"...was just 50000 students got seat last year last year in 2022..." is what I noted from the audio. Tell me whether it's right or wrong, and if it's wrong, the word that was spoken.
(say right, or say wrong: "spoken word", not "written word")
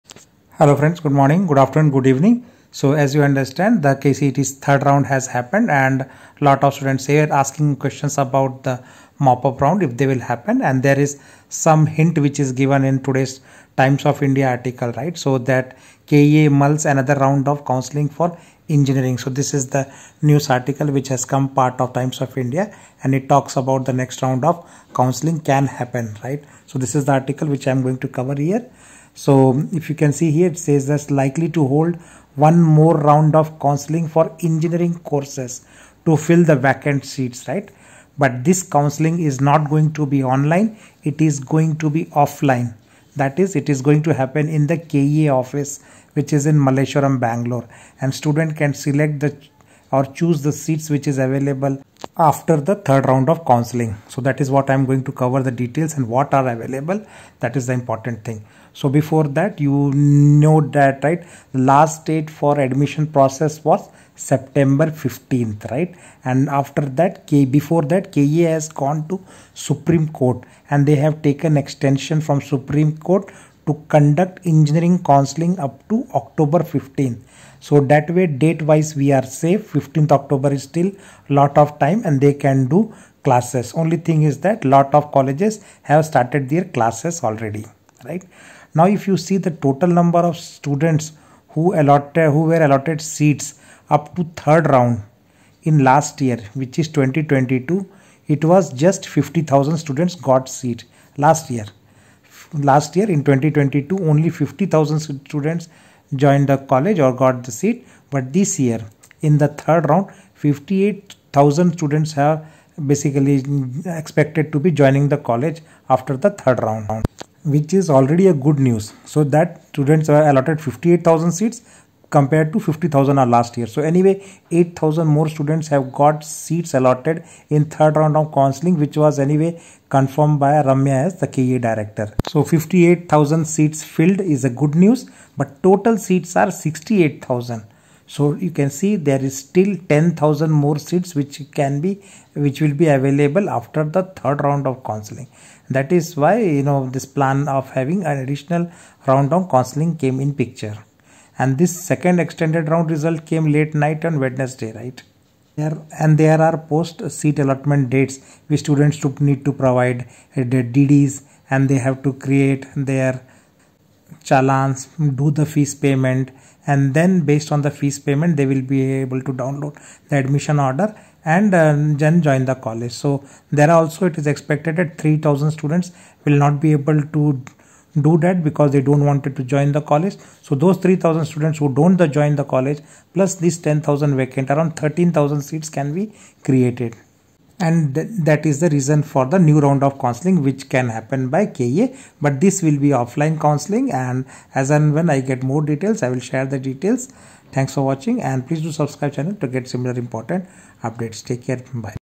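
right.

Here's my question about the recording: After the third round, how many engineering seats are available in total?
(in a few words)
68,000.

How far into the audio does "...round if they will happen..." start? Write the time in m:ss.
0:09.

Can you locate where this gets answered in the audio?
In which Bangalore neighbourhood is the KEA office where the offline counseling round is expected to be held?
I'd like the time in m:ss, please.
0:46.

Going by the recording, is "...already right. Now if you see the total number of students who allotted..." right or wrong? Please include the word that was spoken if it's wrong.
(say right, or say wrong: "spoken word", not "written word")
right.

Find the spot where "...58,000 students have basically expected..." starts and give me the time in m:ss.
1:50.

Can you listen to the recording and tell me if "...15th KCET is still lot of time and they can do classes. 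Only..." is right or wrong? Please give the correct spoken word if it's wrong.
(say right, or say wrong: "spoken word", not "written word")
wrong: "October", not "KCET".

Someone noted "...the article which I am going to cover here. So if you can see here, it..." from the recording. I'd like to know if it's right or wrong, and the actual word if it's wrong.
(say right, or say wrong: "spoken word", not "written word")
right.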